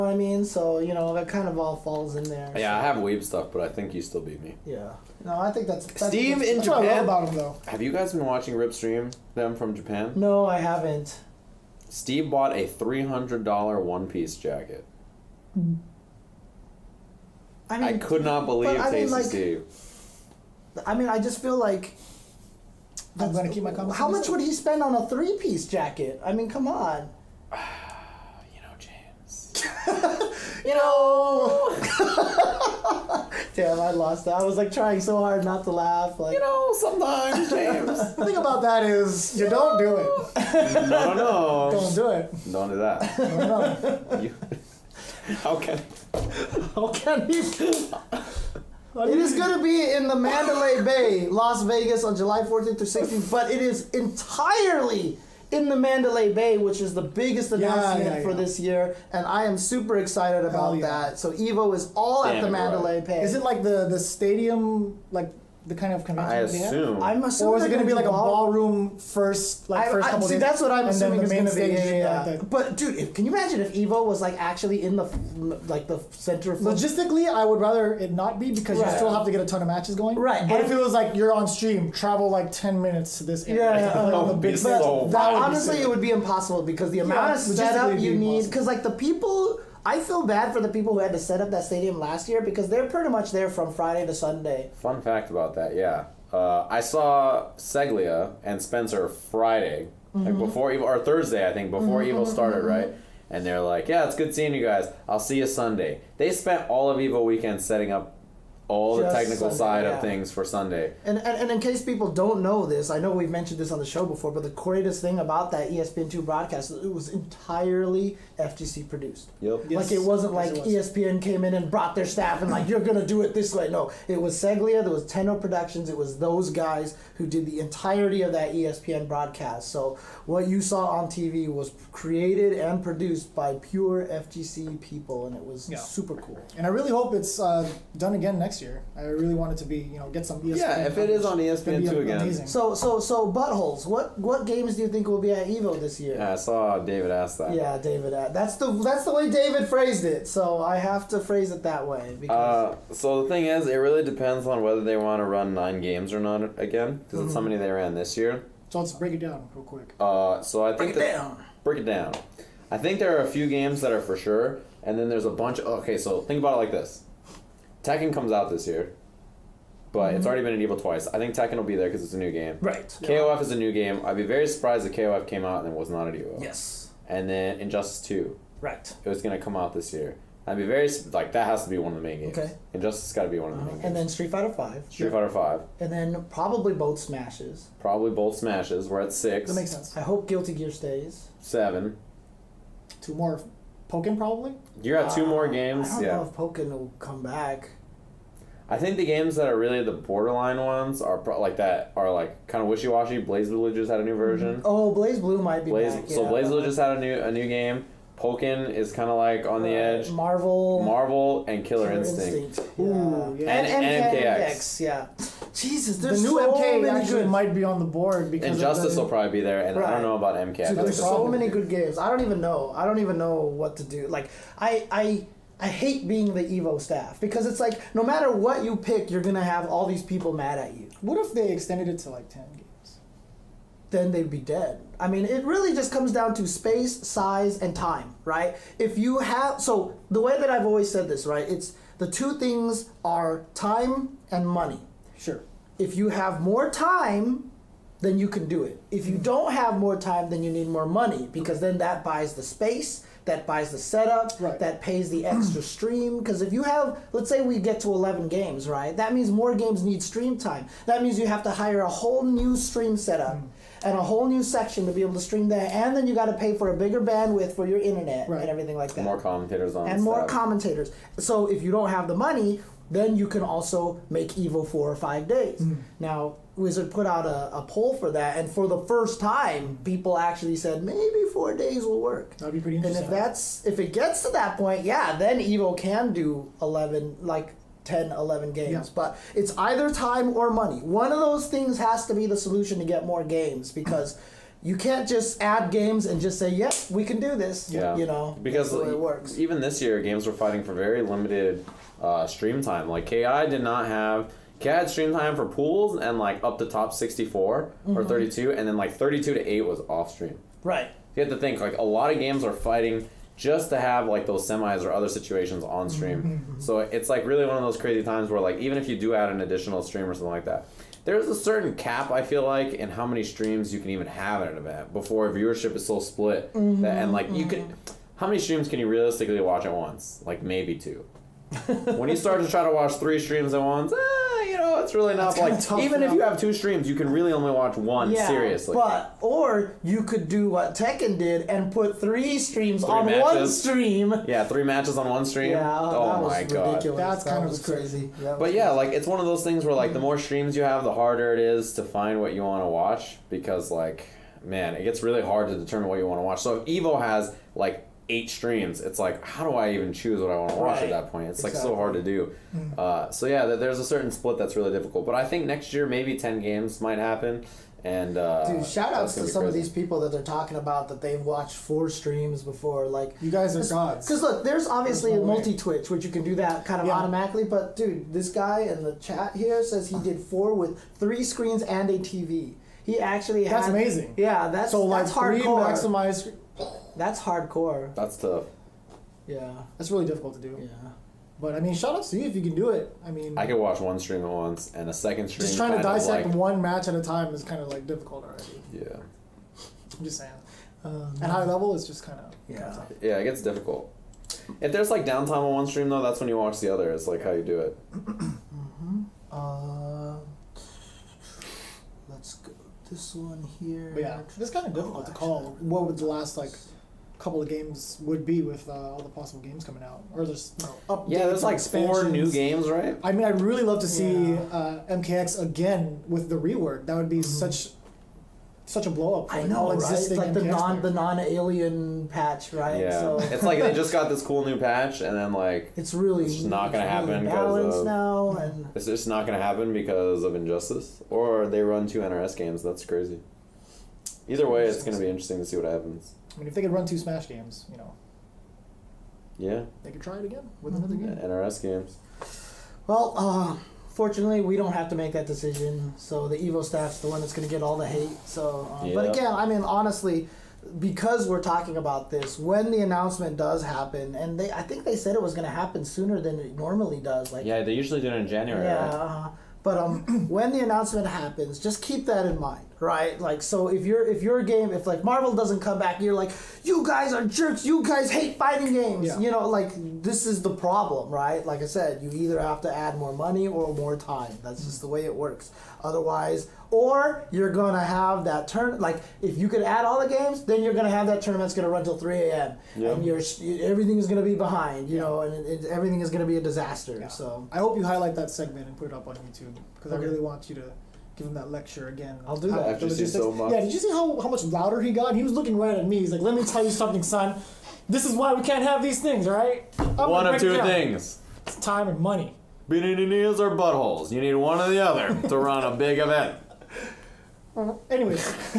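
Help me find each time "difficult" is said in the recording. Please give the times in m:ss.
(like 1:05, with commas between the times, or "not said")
6:04, 6:30, 6:37, 6:43, 6:54.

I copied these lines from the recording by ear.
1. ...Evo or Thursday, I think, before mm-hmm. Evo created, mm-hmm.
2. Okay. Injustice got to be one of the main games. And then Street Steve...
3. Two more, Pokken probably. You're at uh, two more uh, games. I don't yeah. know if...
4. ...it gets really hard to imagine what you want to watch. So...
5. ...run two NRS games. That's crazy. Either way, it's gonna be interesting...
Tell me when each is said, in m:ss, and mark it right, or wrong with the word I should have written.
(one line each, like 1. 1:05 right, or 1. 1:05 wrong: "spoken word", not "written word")
1. 1:40 wrong: "started", not "created"
2. 3:02 wrong: "Fighter", not "Steve"
3. 3:13 right
4. 5:54 wrong: "determine", not "imagine"
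5. 7:21 right.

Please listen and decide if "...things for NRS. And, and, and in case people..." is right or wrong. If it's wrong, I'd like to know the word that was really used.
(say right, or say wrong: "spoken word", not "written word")
wrong: "Sunday", not "NRS".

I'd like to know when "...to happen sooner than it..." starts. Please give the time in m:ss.
7:45.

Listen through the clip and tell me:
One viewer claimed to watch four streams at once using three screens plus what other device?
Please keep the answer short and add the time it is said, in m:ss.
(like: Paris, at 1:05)
a TV, at 6:21.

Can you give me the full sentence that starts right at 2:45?
Of, okay, so think about it like this: Tekken comes out this year, but mm-hmm.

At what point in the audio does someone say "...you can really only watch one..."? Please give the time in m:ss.
5:36.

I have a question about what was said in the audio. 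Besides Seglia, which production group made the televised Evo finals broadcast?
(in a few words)
Tenno Productions.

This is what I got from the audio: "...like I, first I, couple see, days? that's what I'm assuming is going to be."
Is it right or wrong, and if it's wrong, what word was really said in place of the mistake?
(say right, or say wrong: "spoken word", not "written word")
right.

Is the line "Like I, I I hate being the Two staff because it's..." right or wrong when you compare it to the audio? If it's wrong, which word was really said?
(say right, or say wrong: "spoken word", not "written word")
wrong: "Evo", not "Two".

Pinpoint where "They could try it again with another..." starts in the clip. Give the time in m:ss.
7:29.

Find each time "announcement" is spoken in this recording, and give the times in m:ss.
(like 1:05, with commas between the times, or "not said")
0:57, 7:42, 7:50.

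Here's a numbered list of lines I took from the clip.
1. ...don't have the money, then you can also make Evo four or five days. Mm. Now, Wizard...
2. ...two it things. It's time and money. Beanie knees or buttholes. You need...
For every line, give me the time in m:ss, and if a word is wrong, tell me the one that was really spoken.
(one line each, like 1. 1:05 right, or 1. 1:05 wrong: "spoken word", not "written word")
1. 4:31 right
2. 8:30 right.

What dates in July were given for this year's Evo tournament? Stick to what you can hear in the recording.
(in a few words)
July 14th through 16th.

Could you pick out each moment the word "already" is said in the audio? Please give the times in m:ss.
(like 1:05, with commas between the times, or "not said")
2:50, 6:38.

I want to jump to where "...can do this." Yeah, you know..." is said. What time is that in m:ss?
4:57.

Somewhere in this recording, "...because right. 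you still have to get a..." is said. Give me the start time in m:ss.
1:18.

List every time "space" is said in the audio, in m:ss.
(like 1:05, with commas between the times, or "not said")
3:56, 4:12.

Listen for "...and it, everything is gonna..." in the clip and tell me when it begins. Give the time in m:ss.
8:15.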